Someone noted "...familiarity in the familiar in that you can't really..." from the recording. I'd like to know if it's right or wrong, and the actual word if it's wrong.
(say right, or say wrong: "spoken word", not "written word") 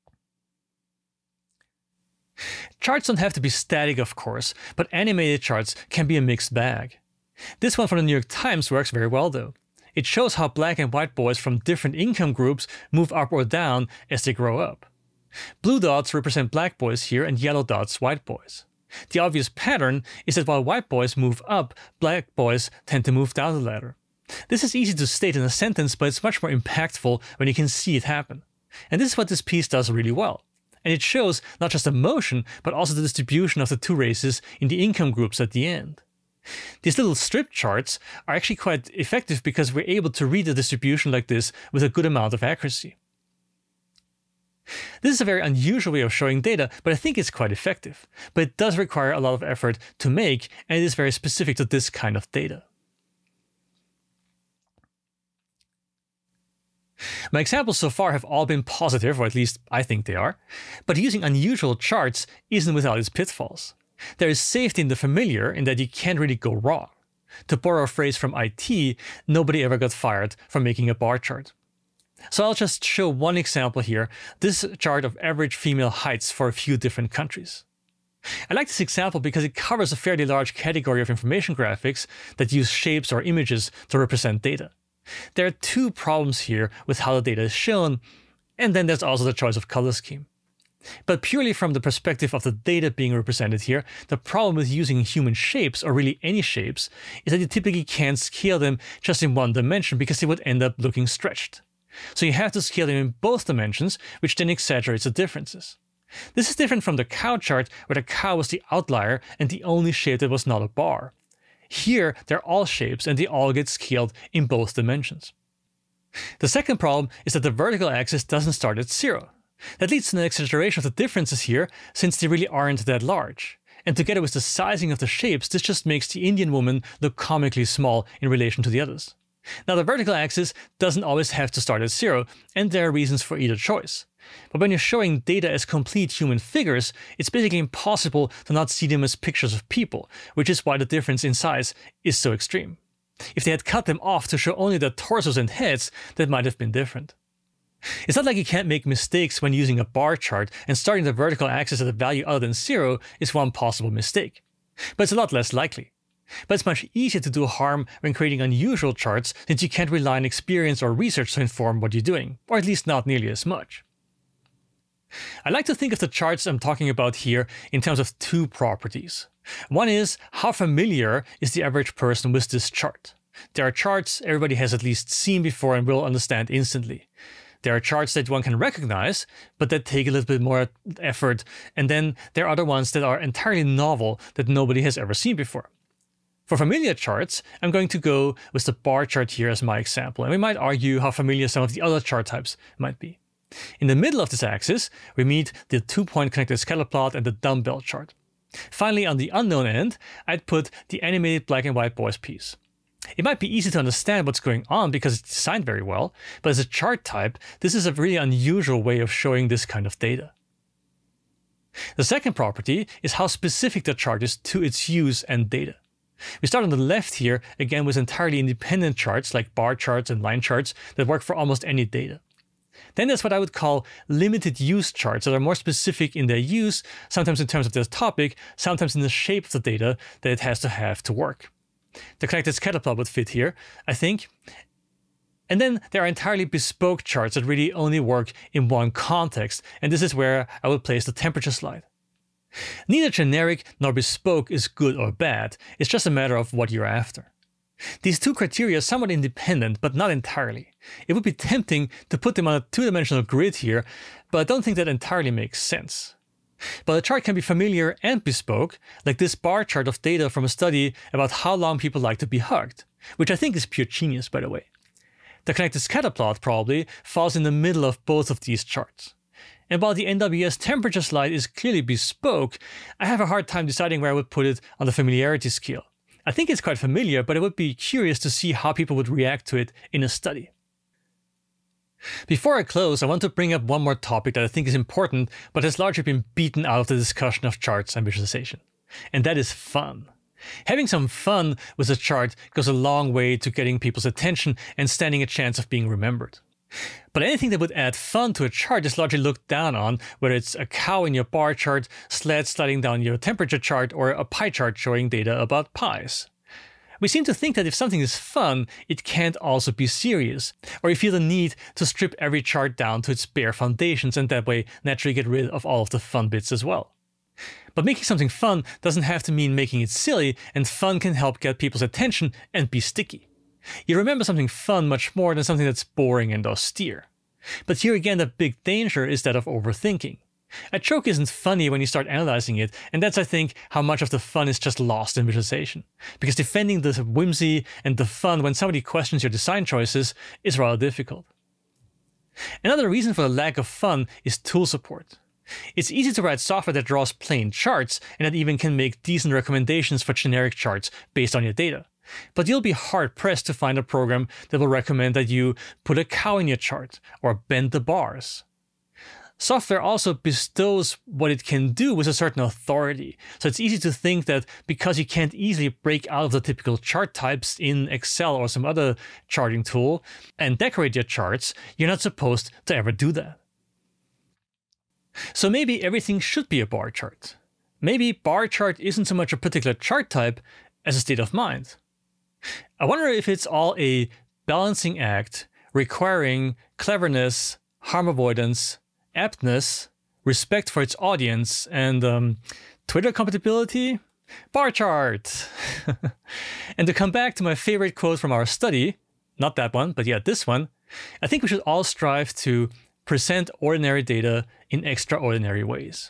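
wrong: "safety", not "familiarity".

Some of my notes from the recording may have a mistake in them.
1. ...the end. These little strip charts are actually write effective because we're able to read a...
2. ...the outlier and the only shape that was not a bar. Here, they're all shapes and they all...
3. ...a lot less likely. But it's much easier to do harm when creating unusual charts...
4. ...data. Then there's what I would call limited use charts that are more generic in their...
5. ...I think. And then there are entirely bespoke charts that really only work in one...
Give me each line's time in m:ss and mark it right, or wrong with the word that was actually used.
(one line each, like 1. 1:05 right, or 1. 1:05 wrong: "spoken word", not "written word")
1. 0:35 wrong: "quite", not "write"
2. 1:48 right
3. 2:35 right
4. 3:41 wrong: "specific", not "generic"
5. 3:53 right.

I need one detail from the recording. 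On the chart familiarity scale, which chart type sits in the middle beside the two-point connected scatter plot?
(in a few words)
Dumbbell chart.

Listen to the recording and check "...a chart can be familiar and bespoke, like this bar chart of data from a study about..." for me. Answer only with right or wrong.
right.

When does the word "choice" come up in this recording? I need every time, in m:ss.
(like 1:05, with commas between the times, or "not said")
1:29, 2:13, 5:39.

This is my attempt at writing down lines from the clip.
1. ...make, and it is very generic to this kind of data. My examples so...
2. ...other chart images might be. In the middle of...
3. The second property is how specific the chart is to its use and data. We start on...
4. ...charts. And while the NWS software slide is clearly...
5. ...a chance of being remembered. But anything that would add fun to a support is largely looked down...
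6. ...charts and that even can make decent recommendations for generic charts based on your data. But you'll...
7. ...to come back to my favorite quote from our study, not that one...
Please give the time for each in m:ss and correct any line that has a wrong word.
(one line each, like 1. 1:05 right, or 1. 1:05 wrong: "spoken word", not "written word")
1. 0:50 wrong: "specific", not "generic"
2. 3:11 wrong: "types", not "images"
3. 3:31 right
4. 4:28 wrong: "temperature", not "software"
5. 4:55 wrong: "chart", not "support"
6. 5:47 right
7. 6:36 right.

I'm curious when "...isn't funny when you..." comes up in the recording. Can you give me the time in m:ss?
5:31.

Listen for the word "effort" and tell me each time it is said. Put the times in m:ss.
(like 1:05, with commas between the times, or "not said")
0:49, 3:00.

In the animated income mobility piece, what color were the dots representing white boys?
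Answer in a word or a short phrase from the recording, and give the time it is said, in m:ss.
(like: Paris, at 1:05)
Yellow, at 0:17.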